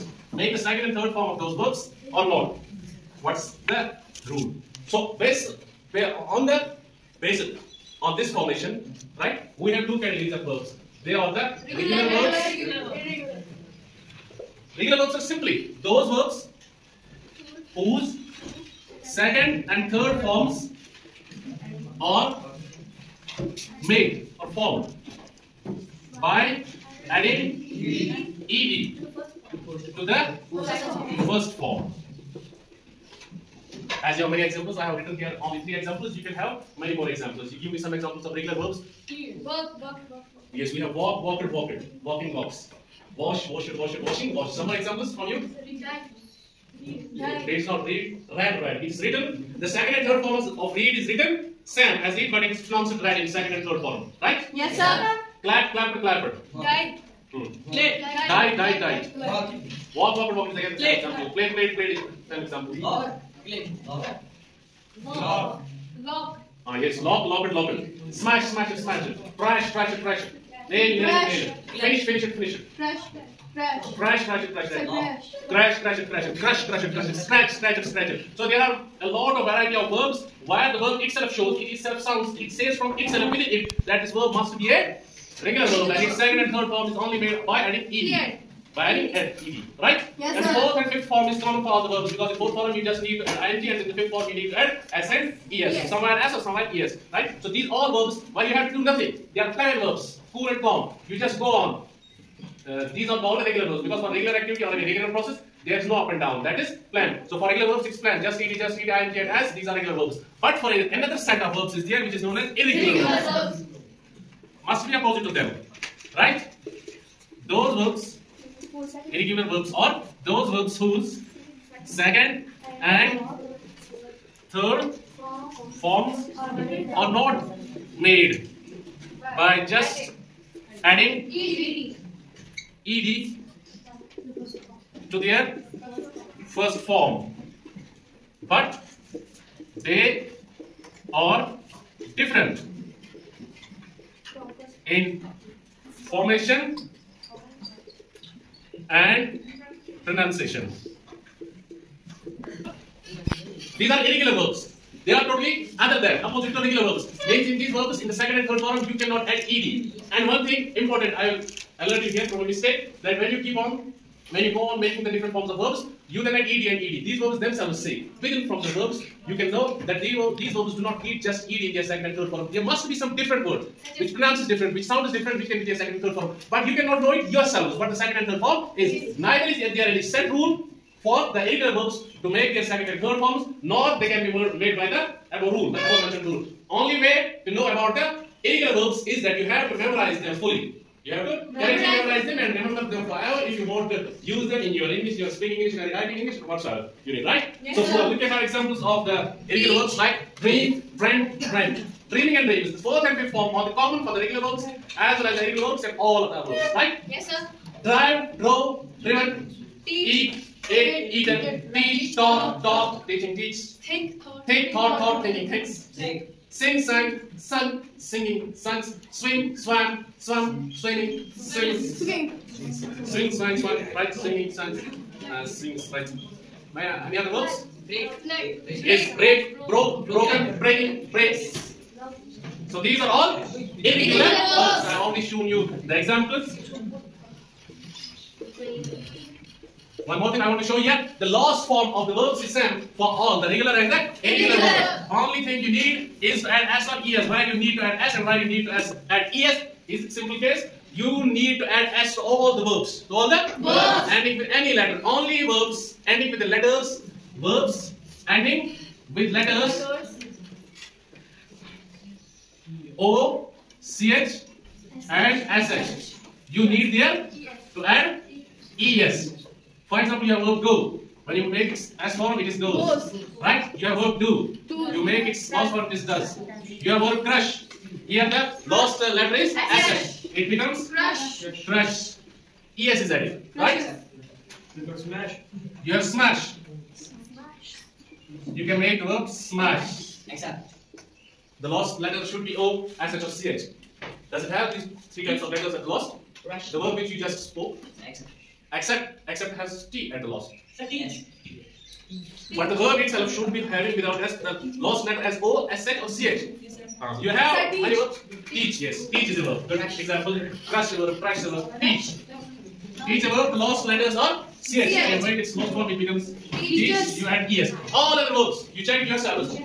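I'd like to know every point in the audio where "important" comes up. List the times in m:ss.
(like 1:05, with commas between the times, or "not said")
2:40.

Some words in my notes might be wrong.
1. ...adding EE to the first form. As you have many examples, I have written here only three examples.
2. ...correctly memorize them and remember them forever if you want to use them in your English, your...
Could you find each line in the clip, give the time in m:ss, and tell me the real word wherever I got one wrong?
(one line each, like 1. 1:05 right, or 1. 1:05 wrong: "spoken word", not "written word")
1. 0:27 right
2. 3:11 right.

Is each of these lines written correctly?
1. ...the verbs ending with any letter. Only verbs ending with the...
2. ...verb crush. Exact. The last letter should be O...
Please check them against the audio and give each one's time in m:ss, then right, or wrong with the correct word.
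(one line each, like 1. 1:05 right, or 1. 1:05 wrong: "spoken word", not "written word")
1. 4:13 right
2. 4:49 wrong: "smash", not "crush".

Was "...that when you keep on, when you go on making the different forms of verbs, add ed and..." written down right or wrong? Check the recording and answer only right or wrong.
right.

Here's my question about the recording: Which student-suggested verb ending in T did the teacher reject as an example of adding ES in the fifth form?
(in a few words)
Accept.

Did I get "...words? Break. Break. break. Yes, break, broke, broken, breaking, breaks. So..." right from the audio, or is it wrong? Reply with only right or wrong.
right.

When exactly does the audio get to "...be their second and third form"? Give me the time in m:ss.
2:55.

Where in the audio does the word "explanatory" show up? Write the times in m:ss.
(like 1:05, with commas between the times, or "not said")
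not said.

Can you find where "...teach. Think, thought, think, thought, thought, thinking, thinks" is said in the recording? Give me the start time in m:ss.
3:33.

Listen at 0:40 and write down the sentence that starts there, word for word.
Yes, we have walk, walked, walked, walking, walks.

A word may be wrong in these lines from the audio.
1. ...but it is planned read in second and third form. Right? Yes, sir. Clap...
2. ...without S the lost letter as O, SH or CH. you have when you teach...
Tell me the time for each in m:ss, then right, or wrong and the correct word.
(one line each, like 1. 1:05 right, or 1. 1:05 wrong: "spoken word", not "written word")
1. 0:52 wrong: "pronounced", not "planned"
2. 5:03 right.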